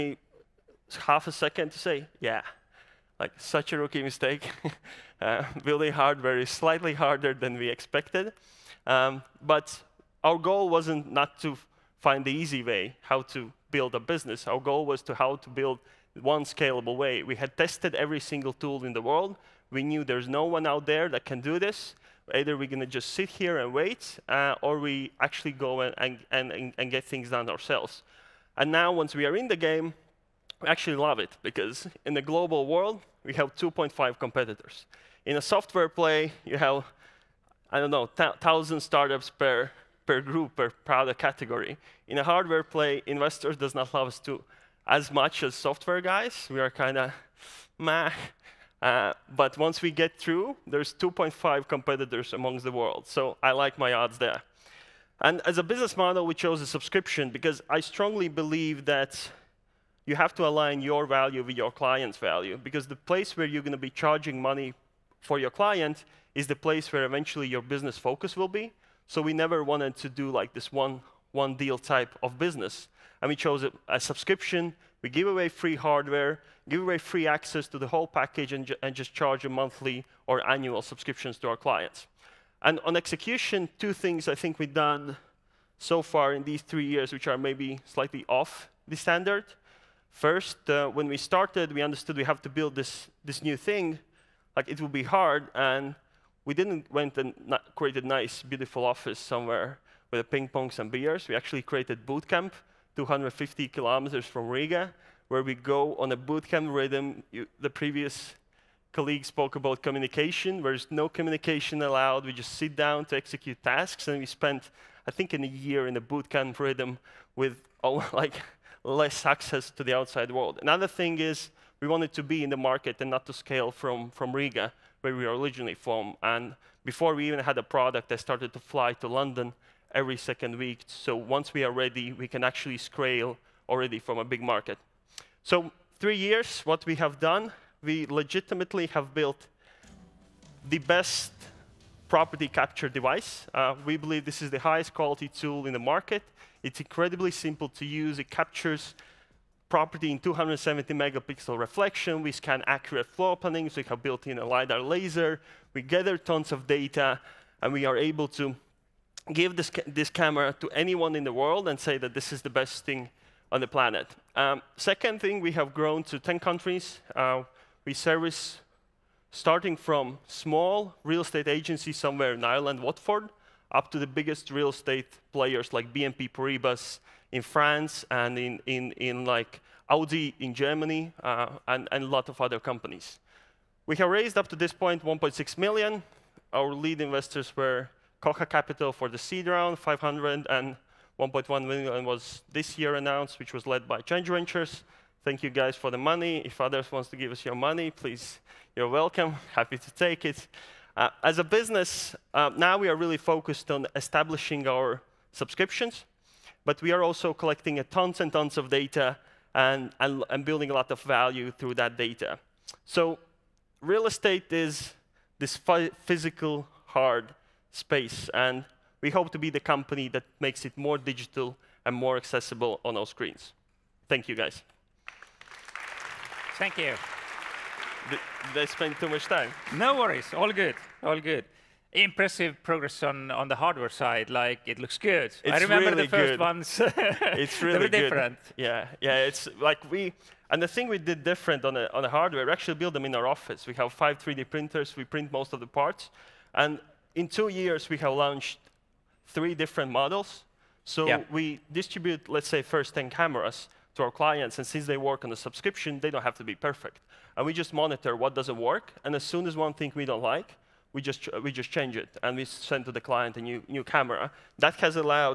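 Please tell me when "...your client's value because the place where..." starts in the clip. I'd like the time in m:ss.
1:01.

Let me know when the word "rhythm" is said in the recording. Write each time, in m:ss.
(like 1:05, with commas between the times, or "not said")
1:46, 1:56.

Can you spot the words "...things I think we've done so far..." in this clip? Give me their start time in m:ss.
1:23.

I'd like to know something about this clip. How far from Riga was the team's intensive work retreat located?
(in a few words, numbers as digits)
250 kilometers.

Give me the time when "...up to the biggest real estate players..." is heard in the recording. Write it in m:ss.
2:53.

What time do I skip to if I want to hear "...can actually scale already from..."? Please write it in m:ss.
2:12.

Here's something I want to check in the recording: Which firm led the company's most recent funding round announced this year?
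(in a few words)
Change Ventures.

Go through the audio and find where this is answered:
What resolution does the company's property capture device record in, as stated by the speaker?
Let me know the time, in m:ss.
2:30.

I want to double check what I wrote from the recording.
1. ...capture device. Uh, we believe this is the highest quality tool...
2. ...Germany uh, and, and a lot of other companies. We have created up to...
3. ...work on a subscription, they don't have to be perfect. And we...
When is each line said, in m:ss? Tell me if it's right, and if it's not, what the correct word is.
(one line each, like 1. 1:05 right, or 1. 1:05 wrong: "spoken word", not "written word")
1. 2:22 right
2. 3:00 wrong: "raised", not "created"
3. 4:14 right.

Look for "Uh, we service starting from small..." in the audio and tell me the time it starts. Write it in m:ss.
2:47.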